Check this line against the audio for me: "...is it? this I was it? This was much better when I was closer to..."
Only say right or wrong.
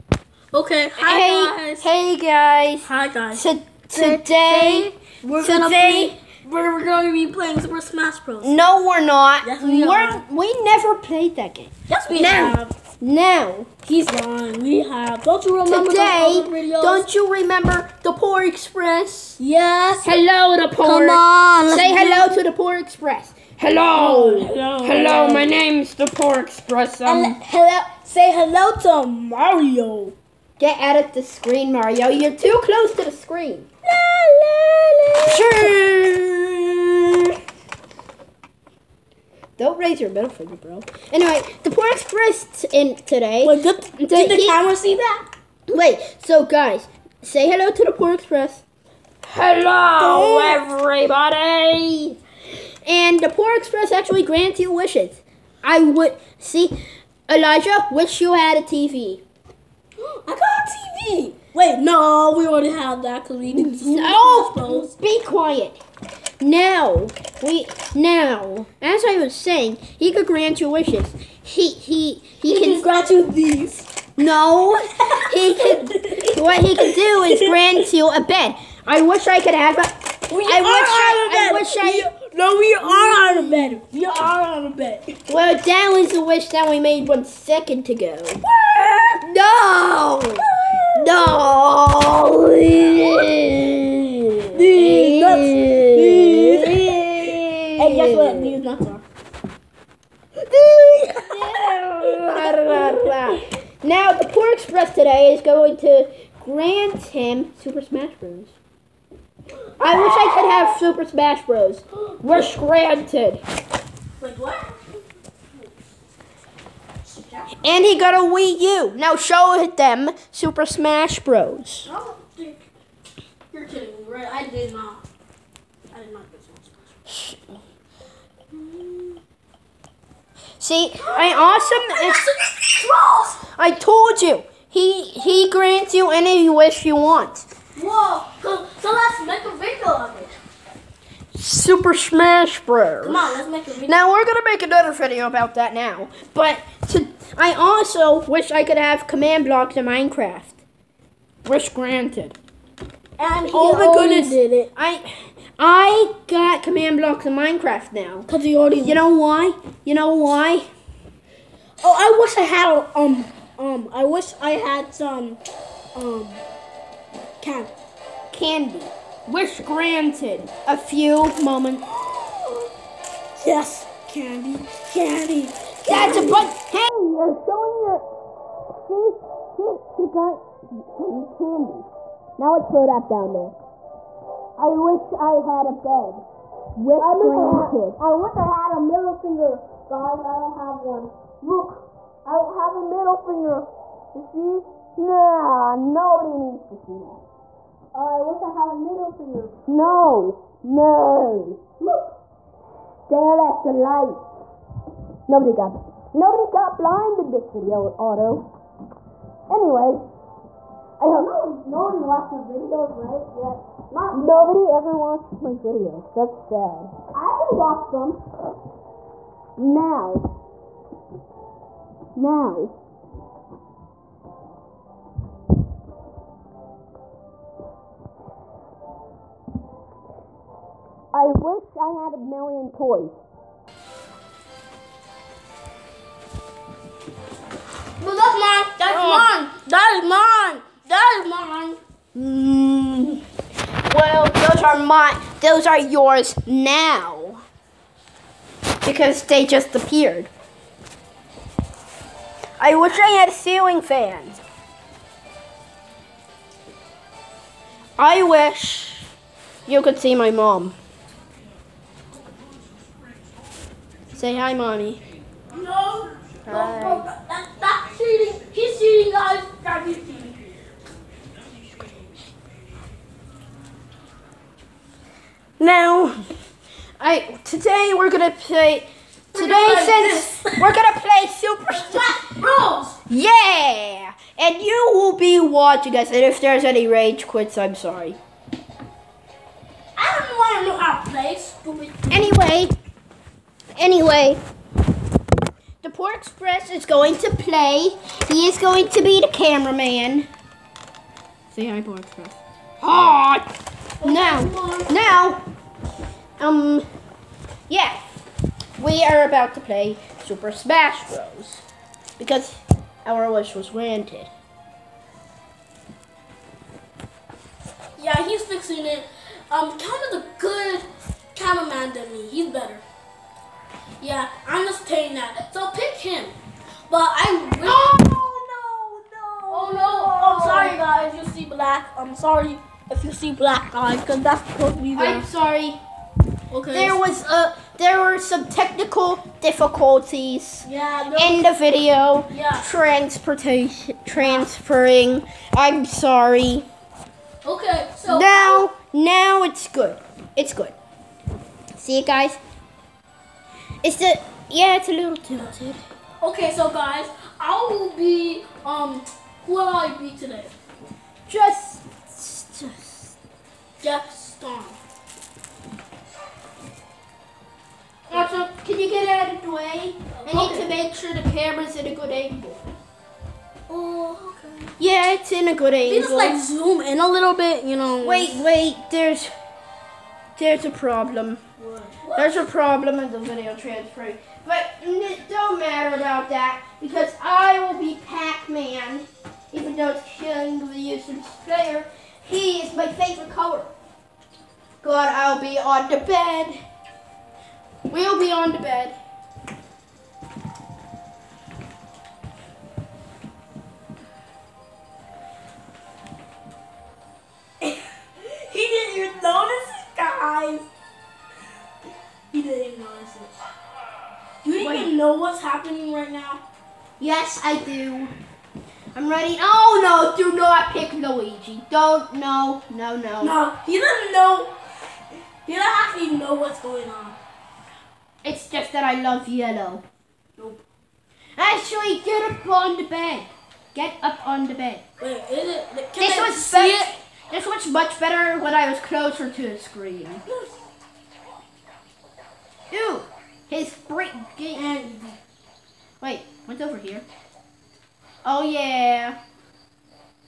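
right.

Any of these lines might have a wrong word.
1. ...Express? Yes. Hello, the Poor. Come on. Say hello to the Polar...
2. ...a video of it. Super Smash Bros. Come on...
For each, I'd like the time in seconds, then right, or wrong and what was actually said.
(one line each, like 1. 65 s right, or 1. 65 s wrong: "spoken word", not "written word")
1. 18 s right
2. 139 s right.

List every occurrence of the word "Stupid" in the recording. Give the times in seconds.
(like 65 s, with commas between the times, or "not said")
291 s.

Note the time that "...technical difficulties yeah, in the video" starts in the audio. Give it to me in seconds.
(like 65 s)
338 s.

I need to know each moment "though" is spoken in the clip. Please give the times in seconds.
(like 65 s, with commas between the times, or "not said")
389 s.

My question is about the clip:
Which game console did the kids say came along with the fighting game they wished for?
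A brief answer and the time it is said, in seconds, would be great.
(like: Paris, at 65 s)
Wii U, at 118 s.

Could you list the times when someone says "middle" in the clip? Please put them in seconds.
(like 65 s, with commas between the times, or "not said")
40 s, 188 s, 192 s, 198 s.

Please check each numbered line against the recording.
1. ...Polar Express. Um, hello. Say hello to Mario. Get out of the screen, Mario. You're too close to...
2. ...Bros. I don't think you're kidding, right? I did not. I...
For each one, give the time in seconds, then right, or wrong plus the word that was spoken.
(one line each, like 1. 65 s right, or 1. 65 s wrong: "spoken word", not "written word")
1. 26 s right
2. 121 s right.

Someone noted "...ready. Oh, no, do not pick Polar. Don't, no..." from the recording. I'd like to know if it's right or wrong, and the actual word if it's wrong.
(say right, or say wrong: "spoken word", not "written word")
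wrong: "Luigi", not "Polar".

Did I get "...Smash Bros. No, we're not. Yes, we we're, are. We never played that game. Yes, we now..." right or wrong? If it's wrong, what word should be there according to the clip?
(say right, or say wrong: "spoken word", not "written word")
right.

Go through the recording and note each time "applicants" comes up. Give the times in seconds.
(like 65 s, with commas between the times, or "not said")
not said.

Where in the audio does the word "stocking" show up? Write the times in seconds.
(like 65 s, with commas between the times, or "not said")
not said.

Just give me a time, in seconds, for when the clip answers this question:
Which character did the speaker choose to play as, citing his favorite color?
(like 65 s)
388 s.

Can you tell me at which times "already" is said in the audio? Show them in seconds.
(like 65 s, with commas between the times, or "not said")
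62 s, 158 s.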